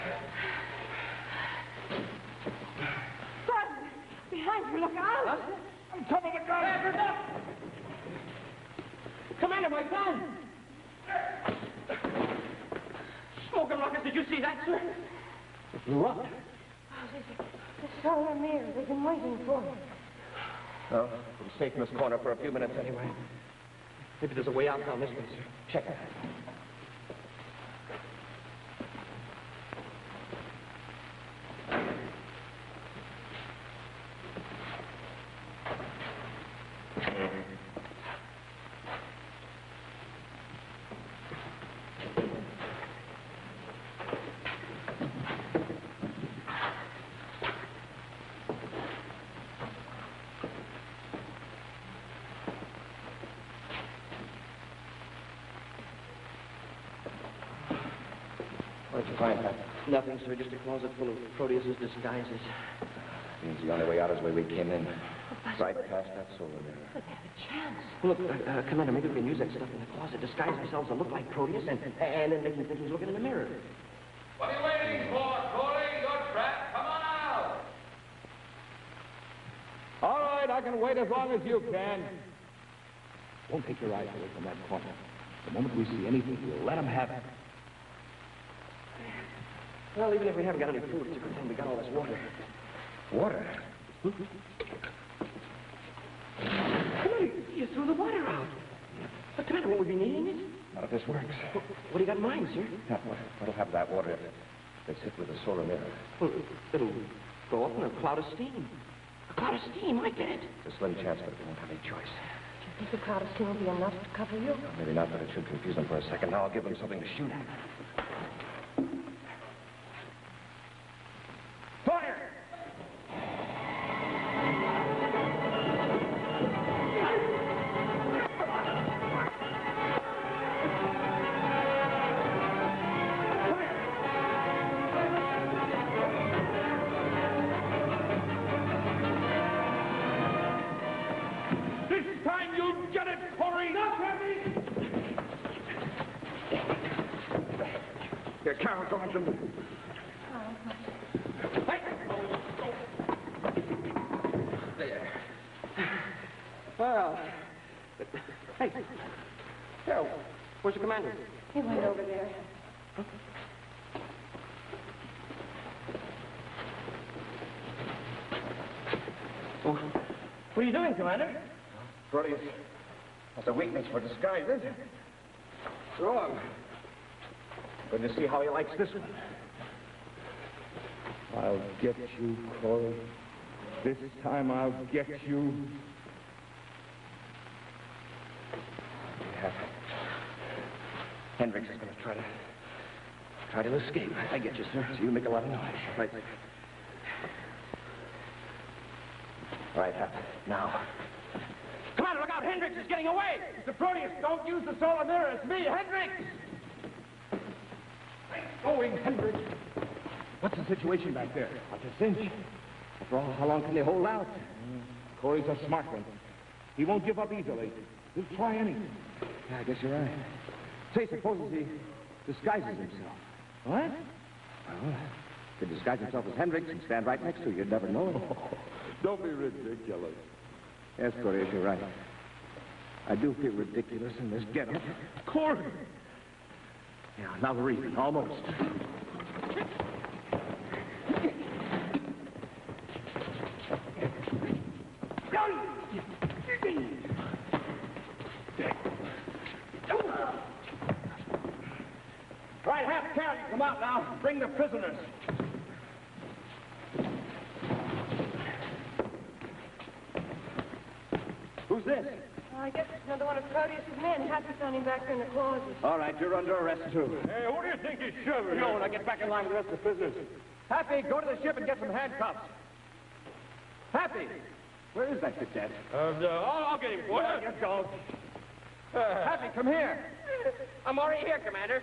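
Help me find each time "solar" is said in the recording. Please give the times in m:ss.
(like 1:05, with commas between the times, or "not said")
1:06, 1:45, 3:24.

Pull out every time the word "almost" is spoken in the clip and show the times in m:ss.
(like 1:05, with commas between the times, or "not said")
3:57.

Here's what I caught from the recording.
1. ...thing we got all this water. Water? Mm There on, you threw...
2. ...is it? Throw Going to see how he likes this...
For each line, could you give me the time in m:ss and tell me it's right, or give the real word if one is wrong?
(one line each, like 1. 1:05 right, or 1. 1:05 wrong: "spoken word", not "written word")
1. 1:31 wrong: "Come", not "There"
2. 2:54 right.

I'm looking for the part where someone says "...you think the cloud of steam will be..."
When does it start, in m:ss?
1:52.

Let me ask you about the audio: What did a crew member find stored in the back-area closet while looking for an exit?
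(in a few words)
Proteus's disguises.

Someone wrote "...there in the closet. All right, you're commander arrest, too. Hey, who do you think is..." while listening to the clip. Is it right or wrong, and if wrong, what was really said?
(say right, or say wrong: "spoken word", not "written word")
wrong: "under", not "commander".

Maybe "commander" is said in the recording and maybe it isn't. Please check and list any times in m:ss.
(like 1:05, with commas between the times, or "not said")
1:08, 2:40, 2:50.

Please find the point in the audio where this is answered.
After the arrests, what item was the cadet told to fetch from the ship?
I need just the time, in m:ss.
4:31.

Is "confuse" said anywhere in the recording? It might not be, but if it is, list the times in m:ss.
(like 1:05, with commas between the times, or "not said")
1:55.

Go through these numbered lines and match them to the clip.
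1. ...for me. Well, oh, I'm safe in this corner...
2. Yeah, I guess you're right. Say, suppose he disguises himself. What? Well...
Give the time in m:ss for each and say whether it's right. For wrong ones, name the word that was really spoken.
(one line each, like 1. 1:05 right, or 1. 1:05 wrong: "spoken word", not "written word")
1. 0:19 right
2. 3:39 right.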